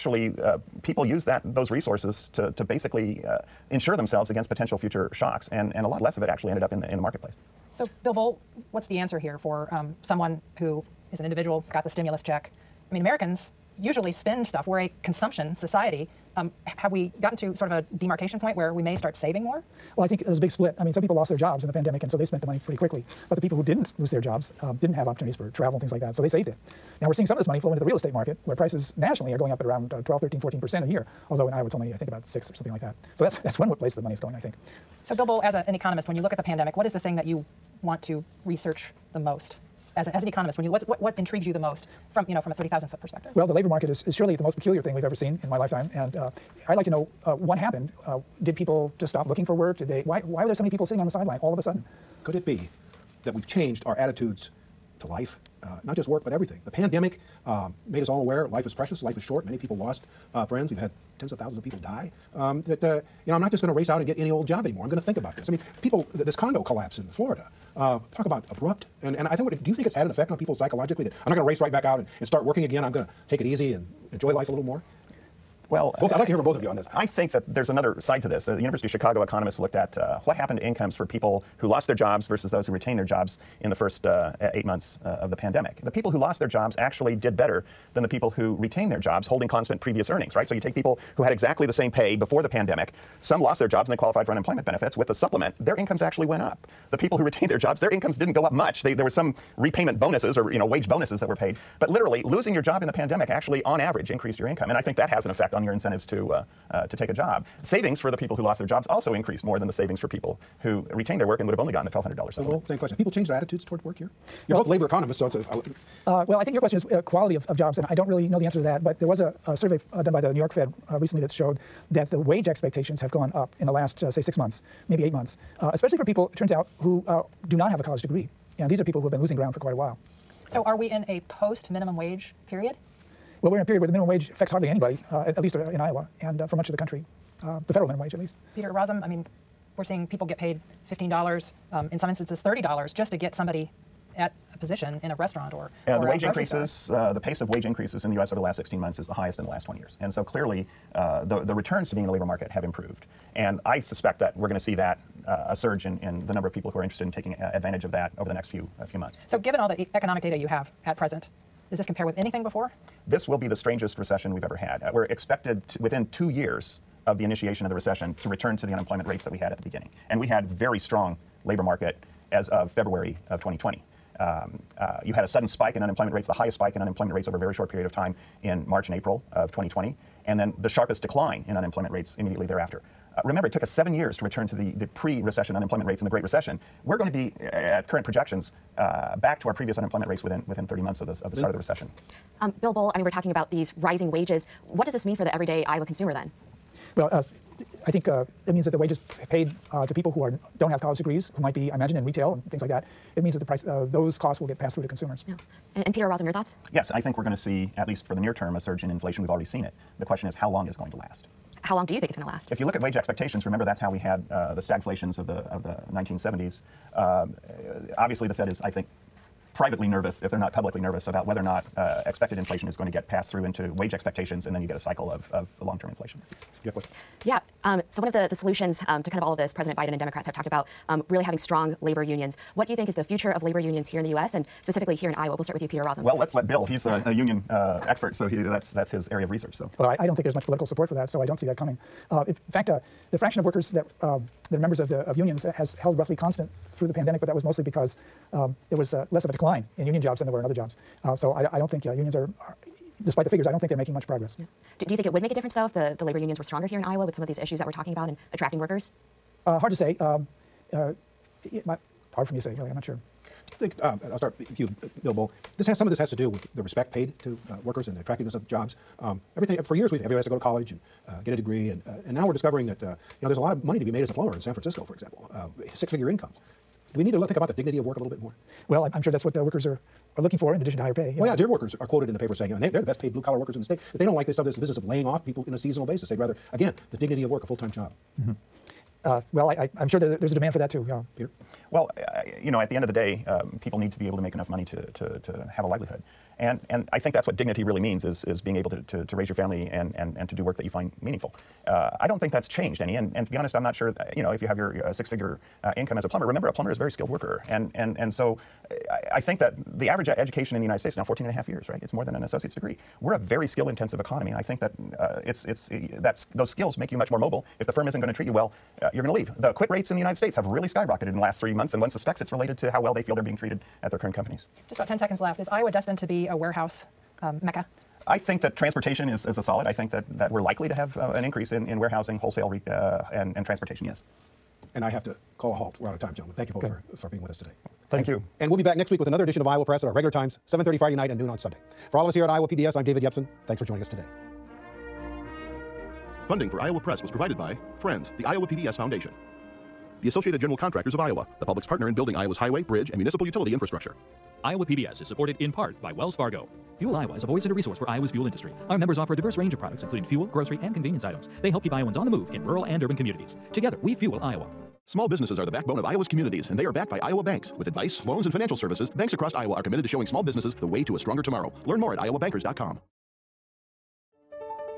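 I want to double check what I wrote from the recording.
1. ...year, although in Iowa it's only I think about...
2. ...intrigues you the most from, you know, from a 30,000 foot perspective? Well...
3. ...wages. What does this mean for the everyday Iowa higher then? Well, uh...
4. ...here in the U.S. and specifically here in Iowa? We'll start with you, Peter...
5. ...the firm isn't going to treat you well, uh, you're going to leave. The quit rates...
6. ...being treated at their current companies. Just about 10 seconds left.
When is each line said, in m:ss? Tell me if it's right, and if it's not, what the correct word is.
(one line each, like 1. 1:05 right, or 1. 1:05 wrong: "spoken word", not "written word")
1. 0:30 right
2. 0:41 right
3. 3:14 wrong: "consumer", not "higher"
4. 3:53 right
5. 5:17 right
6. 5:23 right.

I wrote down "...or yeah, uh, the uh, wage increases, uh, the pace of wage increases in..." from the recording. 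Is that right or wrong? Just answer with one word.
right.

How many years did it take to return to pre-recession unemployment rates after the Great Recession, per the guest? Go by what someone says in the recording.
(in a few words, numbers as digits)
7.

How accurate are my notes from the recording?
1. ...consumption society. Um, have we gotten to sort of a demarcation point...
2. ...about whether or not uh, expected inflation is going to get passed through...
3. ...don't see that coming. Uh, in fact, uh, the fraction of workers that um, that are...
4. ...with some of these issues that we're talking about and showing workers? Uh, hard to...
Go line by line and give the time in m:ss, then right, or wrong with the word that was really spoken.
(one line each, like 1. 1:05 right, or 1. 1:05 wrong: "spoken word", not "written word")
1. 0:15 right
2. 3:41 right
3. 4:01 right
4. 4:17 wrong: "attracting", not "showing".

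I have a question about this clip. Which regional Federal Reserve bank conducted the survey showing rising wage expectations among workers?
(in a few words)
New York Fed.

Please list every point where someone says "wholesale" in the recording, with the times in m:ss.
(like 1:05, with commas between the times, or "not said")
5:32.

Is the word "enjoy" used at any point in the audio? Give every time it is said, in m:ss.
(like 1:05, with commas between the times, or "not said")
1:14.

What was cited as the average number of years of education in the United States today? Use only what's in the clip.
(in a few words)
14 and a half.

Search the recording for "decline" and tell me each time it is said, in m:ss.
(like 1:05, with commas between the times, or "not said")
3:01, 4:09.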